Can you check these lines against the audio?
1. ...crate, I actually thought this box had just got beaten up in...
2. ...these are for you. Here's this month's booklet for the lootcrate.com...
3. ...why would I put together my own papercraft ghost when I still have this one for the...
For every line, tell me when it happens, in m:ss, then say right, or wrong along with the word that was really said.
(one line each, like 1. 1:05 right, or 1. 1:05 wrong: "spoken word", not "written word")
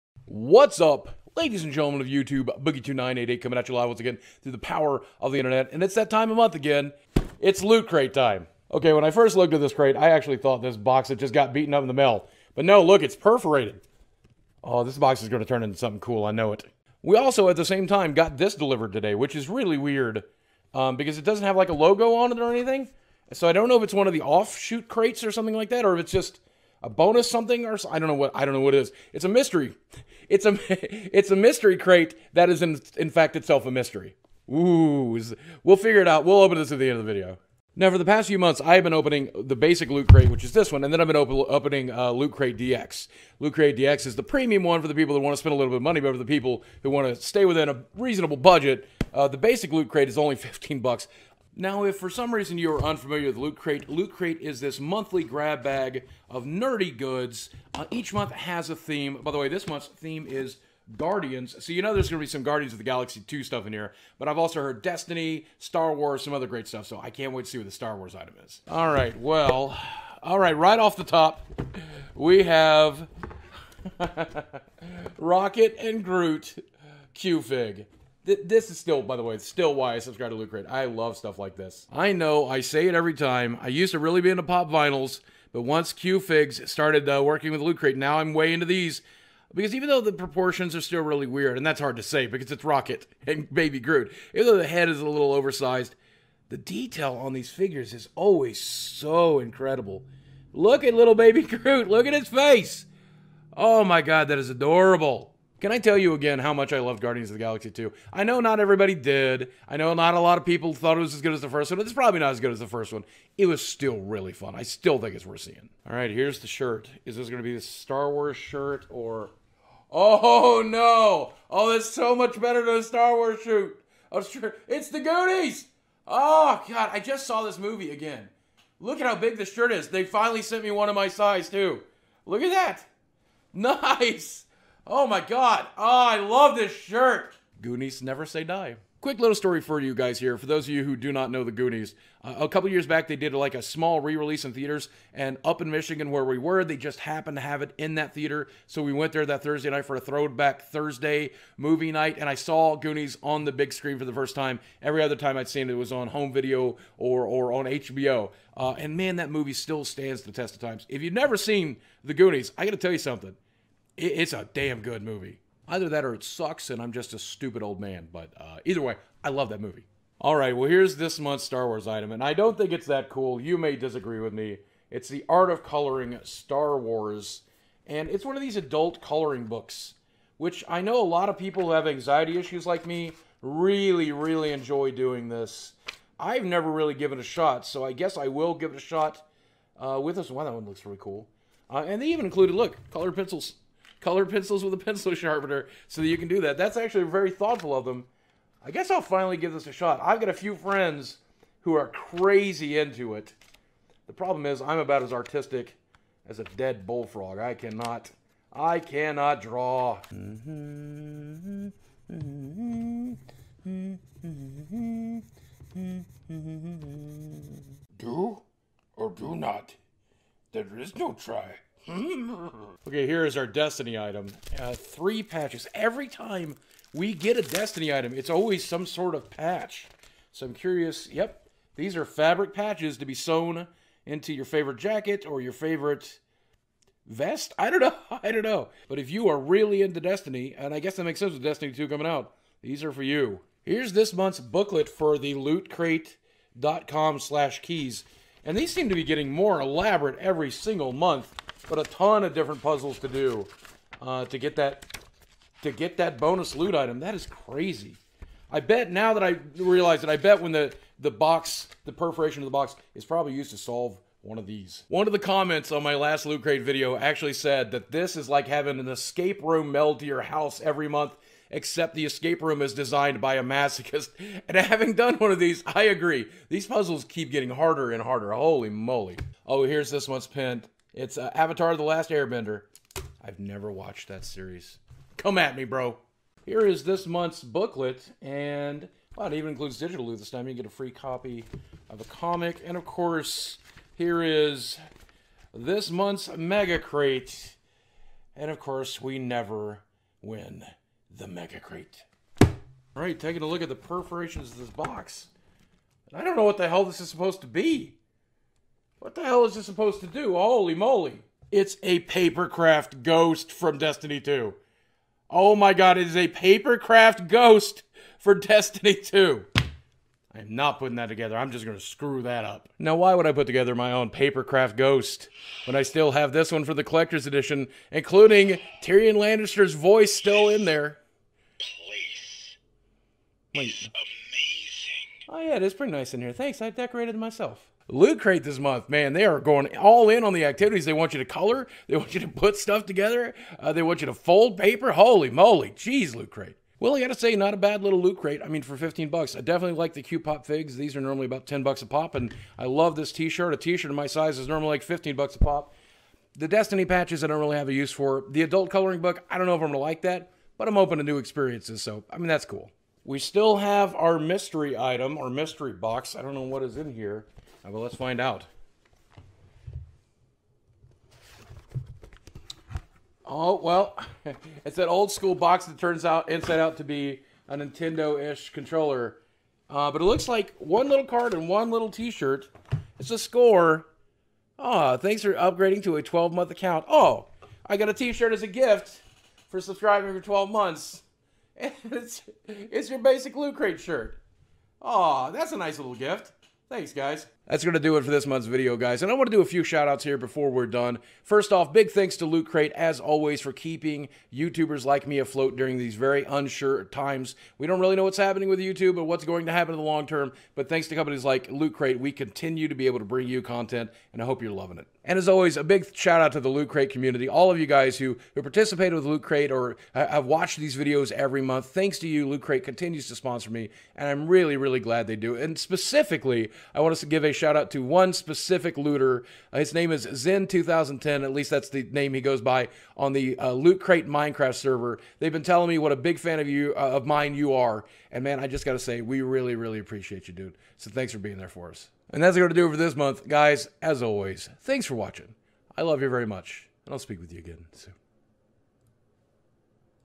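1. 0:09 right
2. 4:02 right
3. 5:22 right.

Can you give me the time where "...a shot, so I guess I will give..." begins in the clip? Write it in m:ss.
3:07.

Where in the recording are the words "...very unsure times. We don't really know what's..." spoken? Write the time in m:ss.
6:45.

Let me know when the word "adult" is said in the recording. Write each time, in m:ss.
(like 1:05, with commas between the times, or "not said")
2:58, 5:58.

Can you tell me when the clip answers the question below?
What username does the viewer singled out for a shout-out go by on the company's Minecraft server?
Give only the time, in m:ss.
7:10.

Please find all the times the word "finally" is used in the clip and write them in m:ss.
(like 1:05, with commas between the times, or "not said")
2:10, 3:19.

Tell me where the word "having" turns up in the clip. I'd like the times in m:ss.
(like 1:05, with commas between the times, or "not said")
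4:28, 4:34.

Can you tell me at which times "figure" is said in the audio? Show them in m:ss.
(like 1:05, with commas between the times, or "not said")
0:35, 1:37.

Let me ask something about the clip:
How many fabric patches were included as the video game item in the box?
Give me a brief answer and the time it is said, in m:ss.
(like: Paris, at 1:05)
3, at 3:44.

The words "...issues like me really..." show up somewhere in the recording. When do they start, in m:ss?
3:02.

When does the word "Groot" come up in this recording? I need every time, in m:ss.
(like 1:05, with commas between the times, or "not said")
1:16, 1:33, 1:41.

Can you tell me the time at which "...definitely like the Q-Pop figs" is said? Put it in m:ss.
5:49.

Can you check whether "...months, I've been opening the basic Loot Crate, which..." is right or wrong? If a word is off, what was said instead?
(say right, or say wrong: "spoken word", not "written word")
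right.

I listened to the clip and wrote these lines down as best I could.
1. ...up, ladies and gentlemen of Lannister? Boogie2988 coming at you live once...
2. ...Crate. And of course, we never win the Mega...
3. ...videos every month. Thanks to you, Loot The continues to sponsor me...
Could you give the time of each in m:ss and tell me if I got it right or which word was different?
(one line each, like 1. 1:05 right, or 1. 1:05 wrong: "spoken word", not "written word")
1. 0:00 wrong: "YouTube", not "Lannister"
2. 4:56 right
3. 7:00 wrong: "Crate", not "The".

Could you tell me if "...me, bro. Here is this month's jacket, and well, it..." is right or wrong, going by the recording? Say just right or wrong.
wrong.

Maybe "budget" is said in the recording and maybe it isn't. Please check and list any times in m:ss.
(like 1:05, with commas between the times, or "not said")
0:48.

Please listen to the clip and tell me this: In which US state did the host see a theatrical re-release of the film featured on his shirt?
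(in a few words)
Michigan.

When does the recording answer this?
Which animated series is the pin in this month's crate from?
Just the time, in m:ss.
4:41.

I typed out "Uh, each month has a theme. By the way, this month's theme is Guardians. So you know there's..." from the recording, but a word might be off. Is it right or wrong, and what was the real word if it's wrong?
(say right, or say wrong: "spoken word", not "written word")
right.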